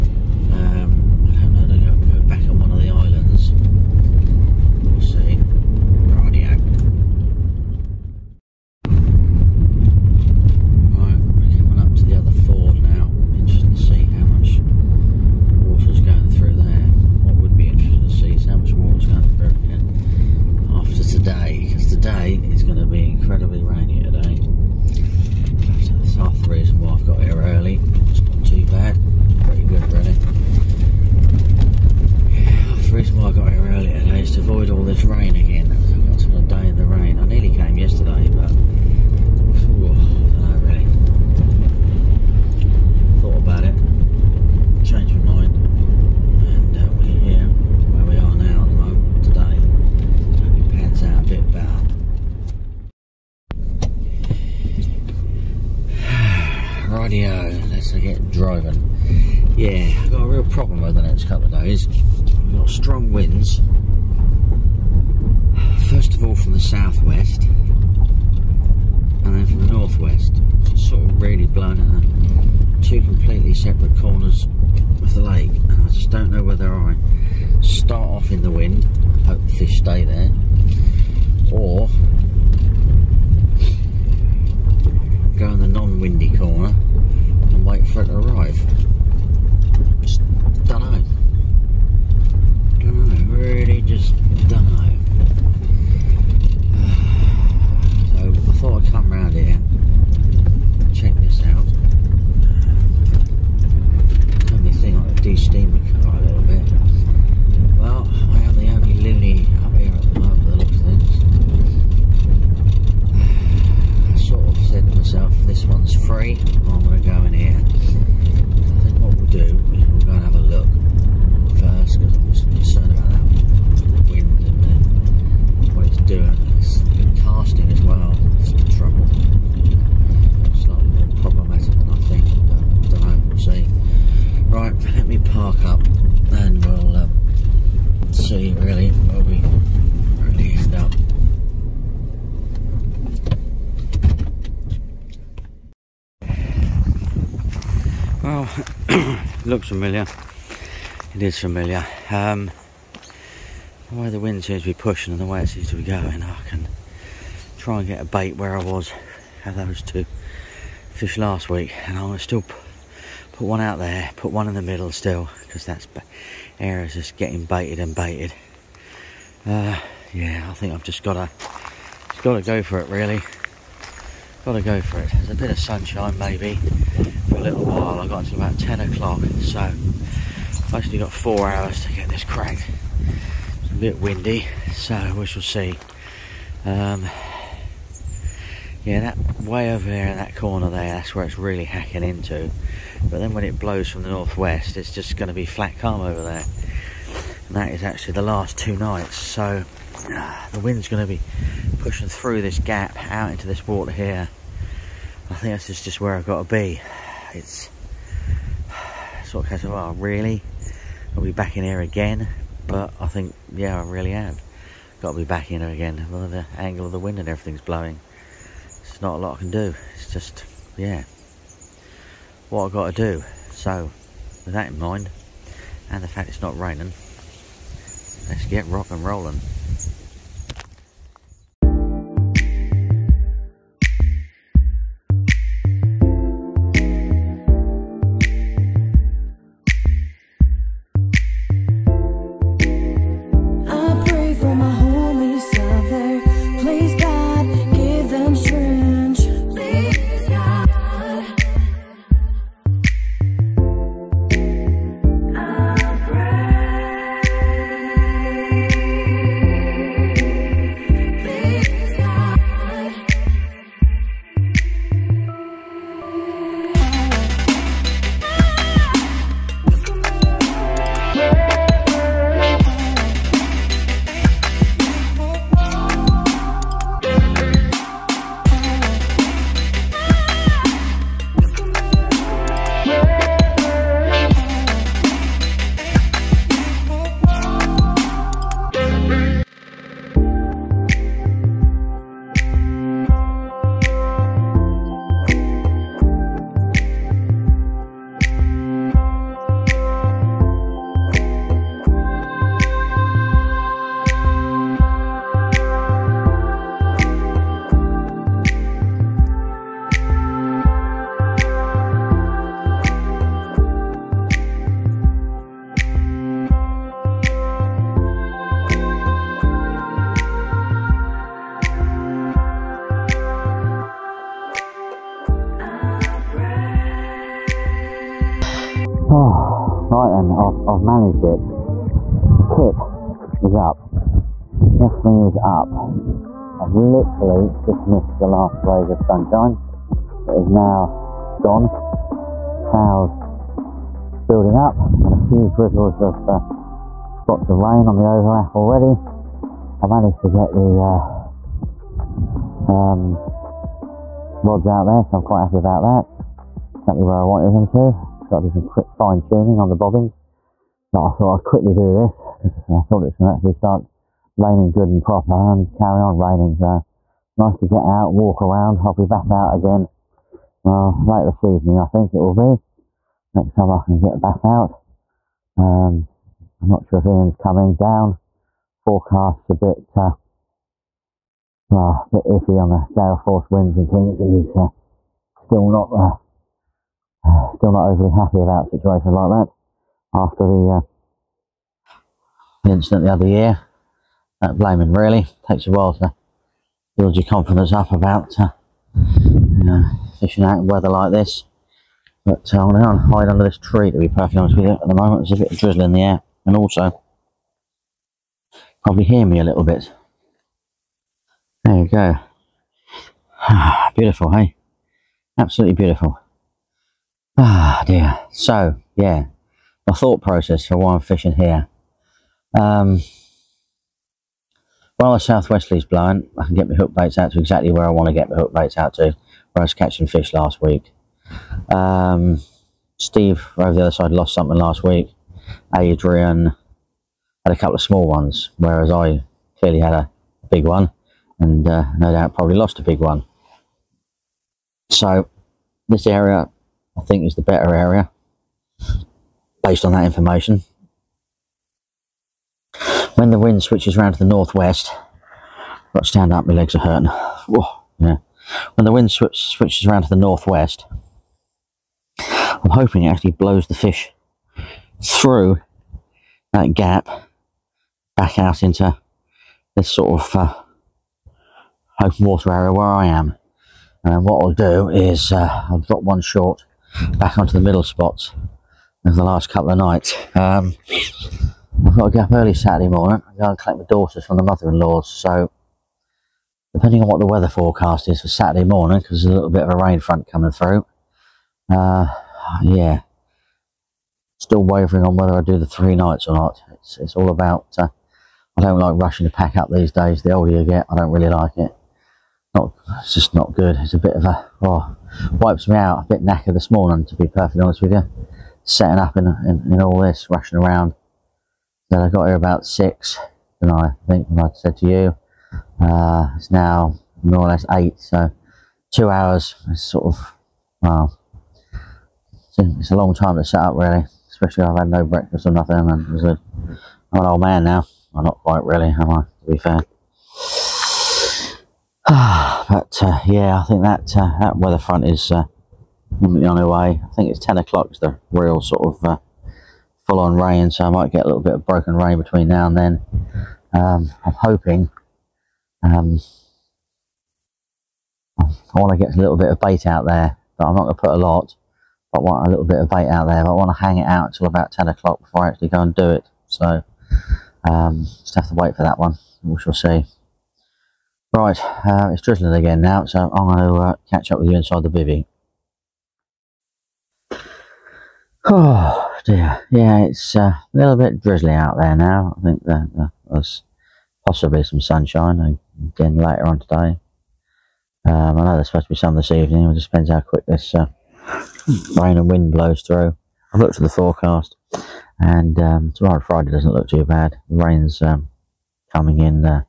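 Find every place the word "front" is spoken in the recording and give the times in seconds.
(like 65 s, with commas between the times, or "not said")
489 s, 534 s.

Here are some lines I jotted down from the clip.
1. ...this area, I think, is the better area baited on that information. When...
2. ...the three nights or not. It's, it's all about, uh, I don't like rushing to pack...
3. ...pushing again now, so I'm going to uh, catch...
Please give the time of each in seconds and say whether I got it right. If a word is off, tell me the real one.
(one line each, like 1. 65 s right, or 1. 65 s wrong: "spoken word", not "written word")
1. 445 s wrong: "based", not "baited"
2. 495 s right
3. 562 s wrong: "drizzling", not "pushing".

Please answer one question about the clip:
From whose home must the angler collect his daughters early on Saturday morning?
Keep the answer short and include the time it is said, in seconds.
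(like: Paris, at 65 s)
The mother-in-law's, at 484 s.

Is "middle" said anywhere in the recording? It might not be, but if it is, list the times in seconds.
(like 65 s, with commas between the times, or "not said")
164 s, 477 s.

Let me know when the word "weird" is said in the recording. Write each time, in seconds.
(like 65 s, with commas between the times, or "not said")
not said.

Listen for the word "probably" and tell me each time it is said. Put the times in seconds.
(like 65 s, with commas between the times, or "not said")
408 s, 442 s.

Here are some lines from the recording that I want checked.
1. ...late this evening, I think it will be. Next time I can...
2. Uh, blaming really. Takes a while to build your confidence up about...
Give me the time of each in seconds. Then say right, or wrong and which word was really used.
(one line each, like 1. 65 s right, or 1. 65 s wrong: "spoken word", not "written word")
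1. 371 s right
2. 394 s right.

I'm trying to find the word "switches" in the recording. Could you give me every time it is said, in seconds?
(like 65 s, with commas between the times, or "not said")
453 s, 459 s.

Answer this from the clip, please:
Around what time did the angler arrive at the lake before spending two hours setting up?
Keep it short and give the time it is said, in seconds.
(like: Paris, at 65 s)
6, at 512 s.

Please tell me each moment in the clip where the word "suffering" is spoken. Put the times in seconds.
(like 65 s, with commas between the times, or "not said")
not said.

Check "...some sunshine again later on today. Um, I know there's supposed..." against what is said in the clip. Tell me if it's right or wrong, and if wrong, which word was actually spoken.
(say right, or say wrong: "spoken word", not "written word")
right.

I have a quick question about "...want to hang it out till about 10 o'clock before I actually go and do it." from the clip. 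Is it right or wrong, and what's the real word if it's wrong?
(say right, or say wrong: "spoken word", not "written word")
right.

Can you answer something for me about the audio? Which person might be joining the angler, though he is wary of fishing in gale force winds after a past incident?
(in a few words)
Ian.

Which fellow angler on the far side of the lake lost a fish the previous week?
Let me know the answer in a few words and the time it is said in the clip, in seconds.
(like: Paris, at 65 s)
Steve, at 432 s.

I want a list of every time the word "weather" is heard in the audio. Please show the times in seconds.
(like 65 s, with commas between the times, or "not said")
400 s, 487 s, 534 s.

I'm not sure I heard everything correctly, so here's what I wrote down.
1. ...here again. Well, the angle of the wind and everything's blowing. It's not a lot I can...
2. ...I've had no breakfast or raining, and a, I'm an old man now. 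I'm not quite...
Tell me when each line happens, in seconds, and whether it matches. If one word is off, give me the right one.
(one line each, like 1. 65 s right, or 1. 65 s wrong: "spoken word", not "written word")
1. 215 s right
2. 524 s wrong: "nothing", not "raining".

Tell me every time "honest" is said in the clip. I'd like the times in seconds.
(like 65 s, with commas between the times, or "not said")
404 s, 507 s.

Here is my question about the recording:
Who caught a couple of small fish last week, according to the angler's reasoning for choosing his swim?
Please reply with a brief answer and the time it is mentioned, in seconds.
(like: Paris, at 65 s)
Adrian, at 435 s.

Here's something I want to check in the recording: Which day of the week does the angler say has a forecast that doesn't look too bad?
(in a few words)
Friday.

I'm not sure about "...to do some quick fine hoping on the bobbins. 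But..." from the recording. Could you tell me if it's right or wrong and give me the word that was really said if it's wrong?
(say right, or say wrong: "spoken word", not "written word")
wrong: "tuning", not "hoping".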